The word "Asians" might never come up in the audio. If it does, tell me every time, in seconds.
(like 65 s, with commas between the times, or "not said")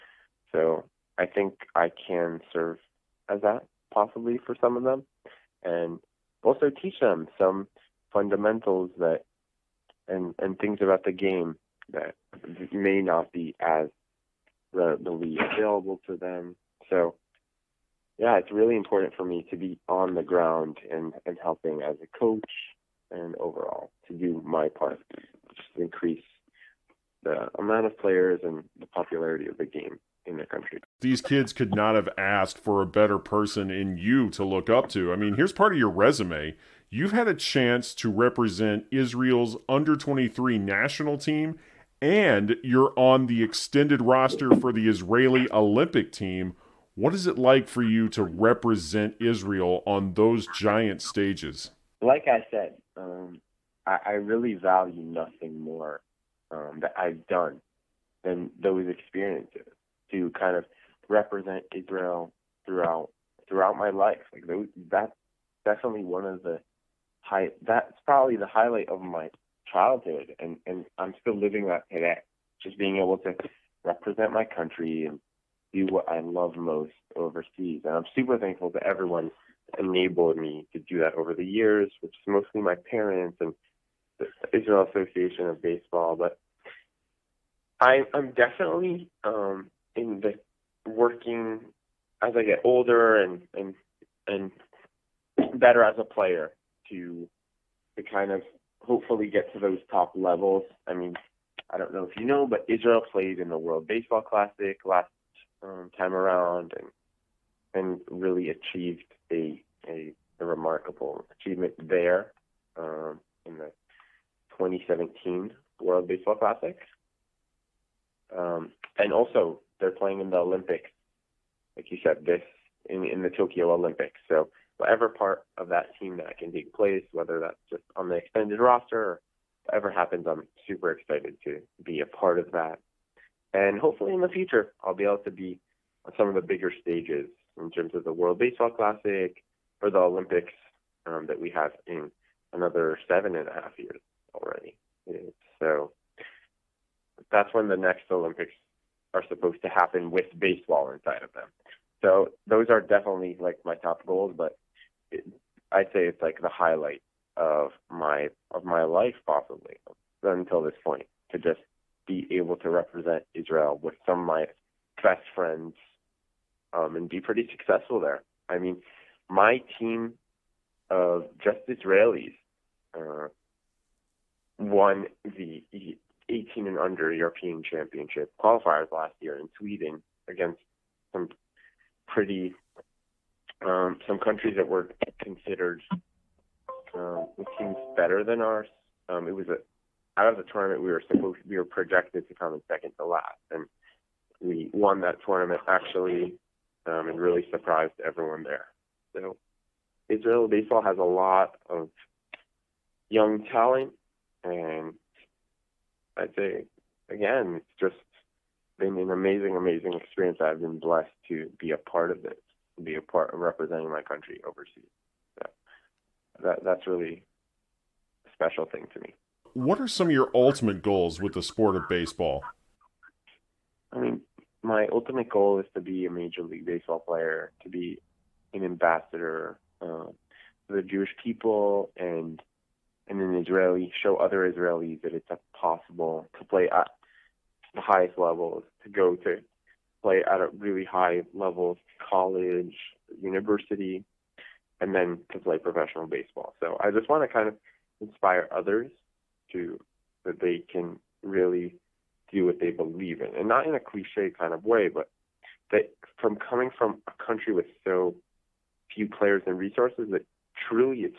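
not said.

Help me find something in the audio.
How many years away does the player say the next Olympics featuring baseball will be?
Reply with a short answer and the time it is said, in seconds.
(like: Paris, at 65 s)
7.5, at 143 s.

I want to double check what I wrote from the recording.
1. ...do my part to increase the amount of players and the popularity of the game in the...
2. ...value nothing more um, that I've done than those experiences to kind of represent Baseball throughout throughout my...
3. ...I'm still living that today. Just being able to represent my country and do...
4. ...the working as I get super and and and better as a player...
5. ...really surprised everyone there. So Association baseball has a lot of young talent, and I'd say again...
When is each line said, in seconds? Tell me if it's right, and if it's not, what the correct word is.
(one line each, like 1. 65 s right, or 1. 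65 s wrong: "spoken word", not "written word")
1. 24 s right
2. 54 s wrong: "Israel", not "Baseball"
3. 70 s right
4. 90 s wrong: "older", not "super"
5. 197 s wrong: "Israel", not "Association".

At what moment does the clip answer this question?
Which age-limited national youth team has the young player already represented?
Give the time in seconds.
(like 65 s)
39 s.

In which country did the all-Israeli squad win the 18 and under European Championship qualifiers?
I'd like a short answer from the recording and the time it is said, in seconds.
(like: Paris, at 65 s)
Sweden, at 179 s.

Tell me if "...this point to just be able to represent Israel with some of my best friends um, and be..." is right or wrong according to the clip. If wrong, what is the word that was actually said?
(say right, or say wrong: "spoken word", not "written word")
right.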